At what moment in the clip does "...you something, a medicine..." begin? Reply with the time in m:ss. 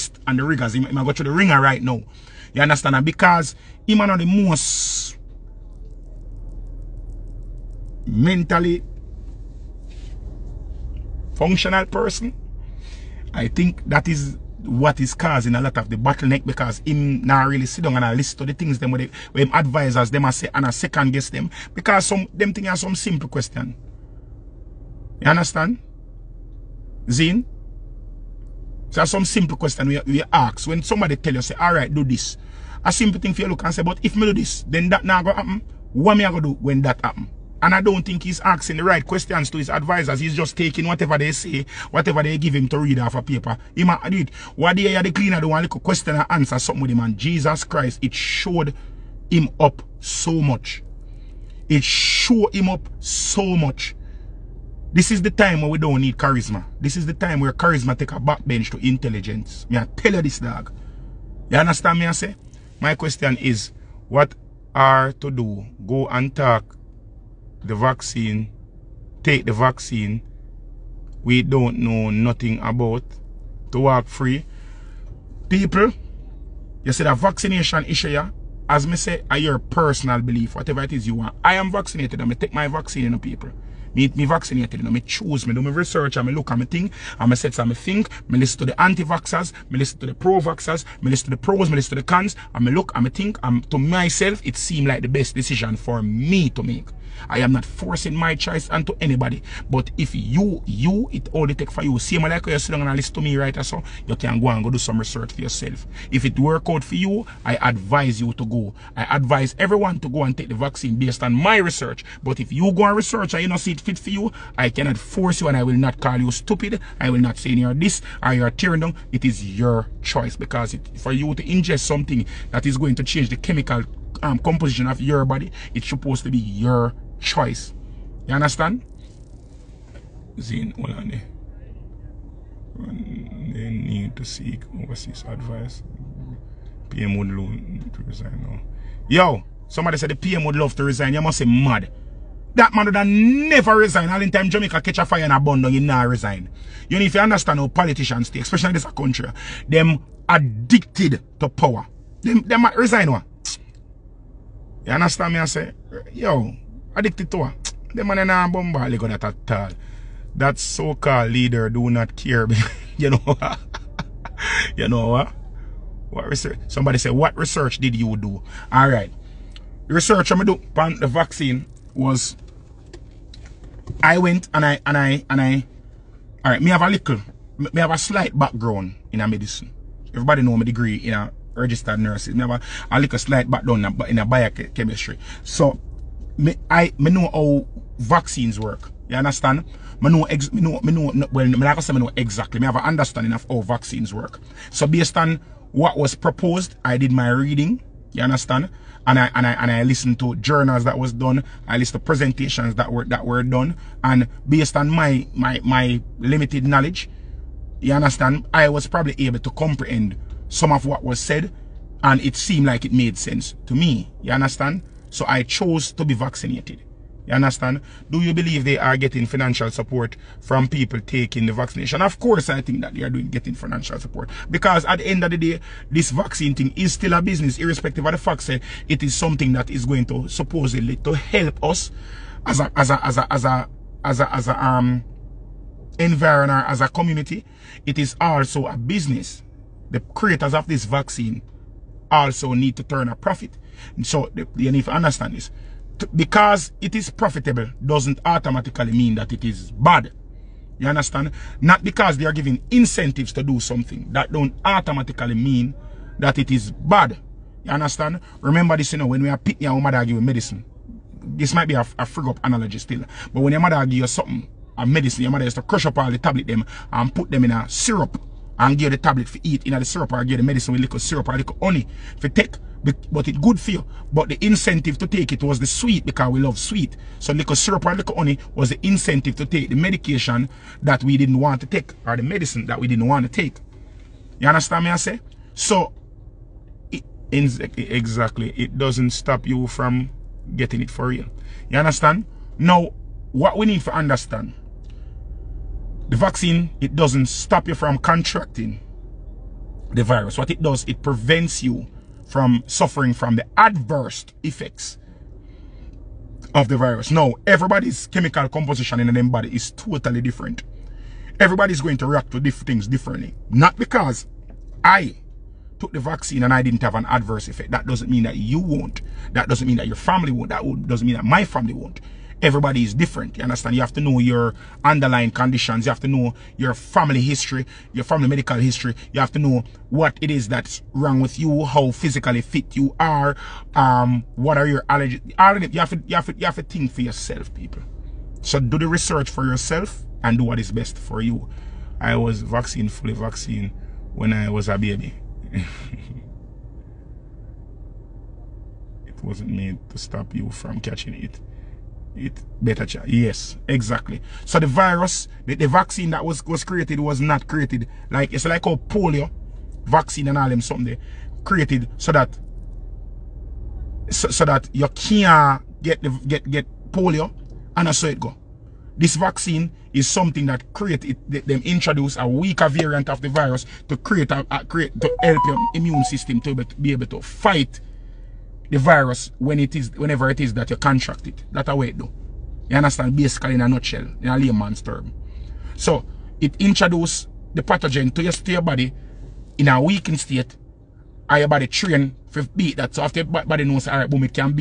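4:23.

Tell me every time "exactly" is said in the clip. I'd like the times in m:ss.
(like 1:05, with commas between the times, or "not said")
3:12, 4:47, 5:53.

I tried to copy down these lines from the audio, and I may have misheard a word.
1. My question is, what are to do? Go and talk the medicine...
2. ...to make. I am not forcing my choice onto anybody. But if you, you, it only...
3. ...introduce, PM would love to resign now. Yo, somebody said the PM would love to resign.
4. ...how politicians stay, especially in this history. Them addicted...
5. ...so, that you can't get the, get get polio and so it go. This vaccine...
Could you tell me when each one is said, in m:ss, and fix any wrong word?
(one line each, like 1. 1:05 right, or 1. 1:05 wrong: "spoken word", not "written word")
1. 1:02 wrong: "vaccine", not "medicine"
2. 1:36 right
3. 2:15 wrong: "advice", not "introduce"
4. 2:27 wrong: "country", not "history"
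5. 6:04 right.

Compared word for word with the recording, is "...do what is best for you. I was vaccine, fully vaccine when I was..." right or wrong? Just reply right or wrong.
right.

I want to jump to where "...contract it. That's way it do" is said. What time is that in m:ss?
6:20.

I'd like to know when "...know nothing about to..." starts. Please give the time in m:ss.
1:11.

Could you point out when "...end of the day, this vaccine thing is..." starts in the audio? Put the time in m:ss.
3:45.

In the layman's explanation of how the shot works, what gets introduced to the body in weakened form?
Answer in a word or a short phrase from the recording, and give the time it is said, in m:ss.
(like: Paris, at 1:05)
pathogen, at 6:27.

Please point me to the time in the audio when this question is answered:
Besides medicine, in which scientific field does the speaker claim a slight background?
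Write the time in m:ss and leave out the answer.
3:04.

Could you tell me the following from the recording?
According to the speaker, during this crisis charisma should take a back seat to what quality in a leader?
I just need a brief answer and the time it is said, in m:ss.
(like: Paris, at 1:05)
intelligence, at 0:58.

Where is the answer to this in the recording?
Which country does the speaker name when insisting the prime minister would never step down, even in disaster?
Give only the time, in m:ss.
2:24.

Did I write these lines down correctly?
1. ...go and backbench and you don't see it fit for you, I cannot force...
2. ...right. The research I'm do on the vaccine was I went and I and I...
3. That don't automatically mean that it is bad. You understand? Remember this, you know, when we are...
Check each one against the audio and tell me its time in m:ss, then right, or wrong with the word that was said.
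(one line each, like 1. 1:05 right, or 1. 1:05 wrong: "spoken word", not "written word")
1. 1:52 wrong: "research", not "backbench"
2. 2:48 right
3. 4:14 right.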